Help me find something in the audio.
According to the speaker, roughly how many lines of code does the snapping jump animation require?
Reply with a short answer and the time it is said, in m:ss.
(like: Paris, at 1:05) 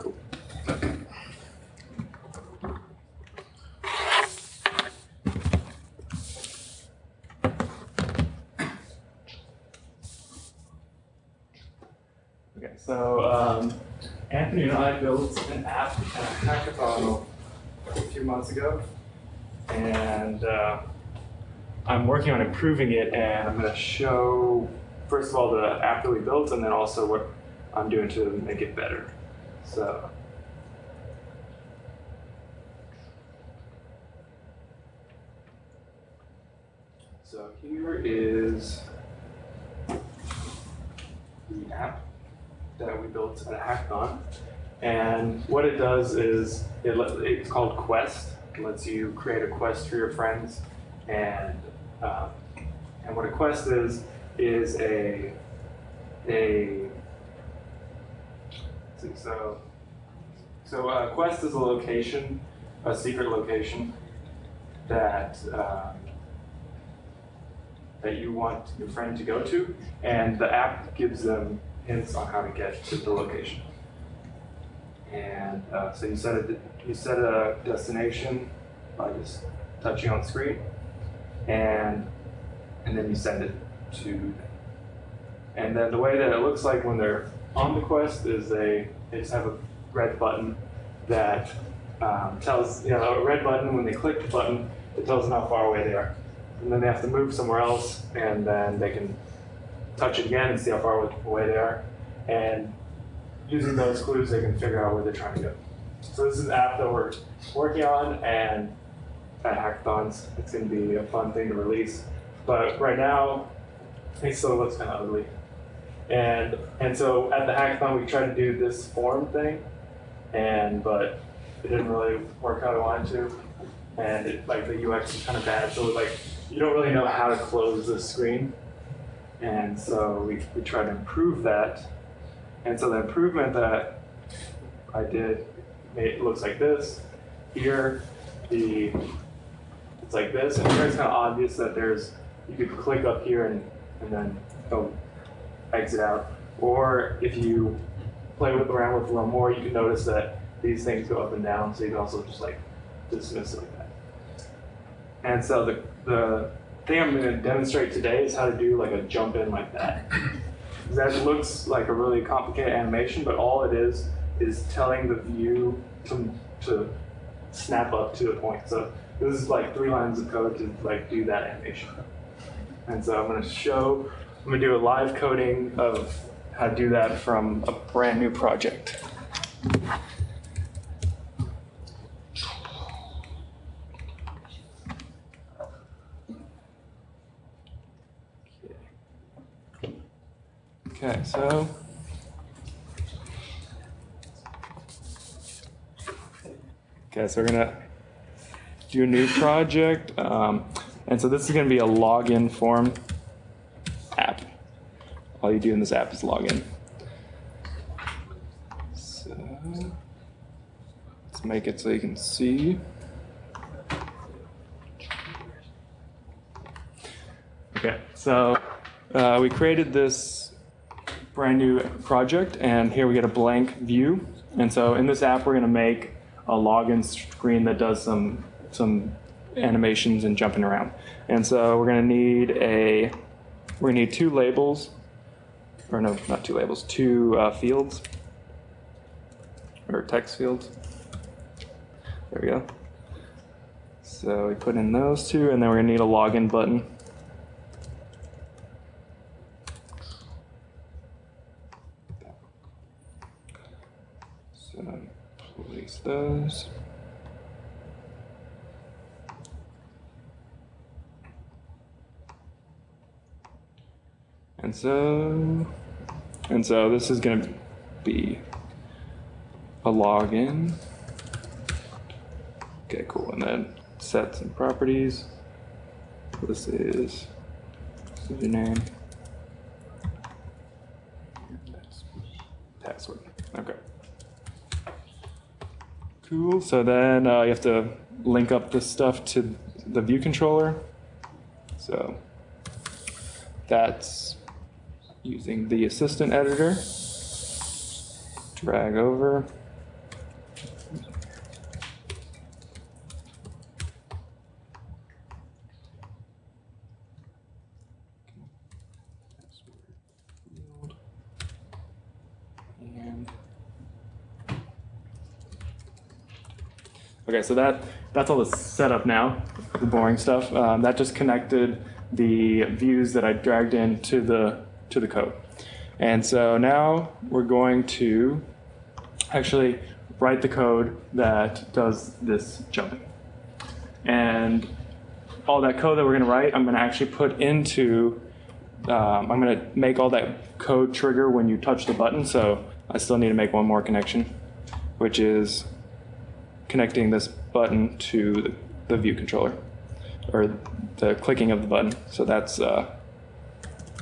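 3, at 2:49.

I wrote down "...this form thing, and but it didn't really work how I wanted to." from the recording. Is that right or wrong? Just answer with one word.
right.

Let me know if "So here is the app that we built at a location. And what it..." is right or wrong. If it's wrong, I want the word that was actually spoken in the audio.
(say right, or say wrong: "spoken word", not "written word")
wrong: "hackathon", not "location".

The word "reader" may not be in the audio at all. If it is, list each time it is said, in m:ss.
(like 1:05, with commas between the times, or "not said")
not said.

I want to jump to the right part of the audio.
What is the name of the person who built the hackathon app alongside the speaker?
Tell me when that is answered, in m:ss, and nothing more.
0:14.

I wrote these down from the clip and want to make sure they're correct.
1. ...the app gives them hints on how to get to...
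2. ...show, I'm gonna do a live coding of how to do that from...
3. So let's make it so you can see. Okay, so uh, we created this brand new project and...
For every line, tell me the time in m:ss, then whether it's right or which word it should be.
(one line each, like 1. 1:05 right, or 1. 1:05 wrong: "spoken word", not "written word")
1. 1:10 right
2. 2:53 right
3. 3:28 right.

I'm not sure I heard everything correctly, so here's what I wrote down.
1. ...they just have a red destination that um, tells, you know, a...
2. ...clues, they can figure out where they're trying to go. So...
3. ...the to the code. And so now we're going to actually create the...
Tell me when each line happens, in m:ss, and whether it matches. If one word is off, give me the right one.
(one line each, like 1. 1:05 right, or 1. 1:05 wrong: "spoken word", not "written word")
1. 1:29 wrong: "button", not "destination"
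2. 1:44 right
3. 5:24 wrong: "write", not "create".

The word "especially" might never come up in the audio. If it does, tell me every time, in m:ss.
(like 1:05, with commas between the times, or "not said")
not said.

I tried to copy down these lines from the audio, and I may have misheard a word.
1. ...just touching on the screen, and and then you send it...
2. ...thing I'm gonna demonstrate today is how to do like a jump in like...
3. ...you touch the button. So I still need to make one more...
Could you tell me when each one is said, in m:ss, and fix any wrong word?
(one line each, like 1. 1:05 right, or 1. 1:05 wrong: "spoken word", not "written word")
1. 1:19 right
2. 2:36 right
3. 5:41 right.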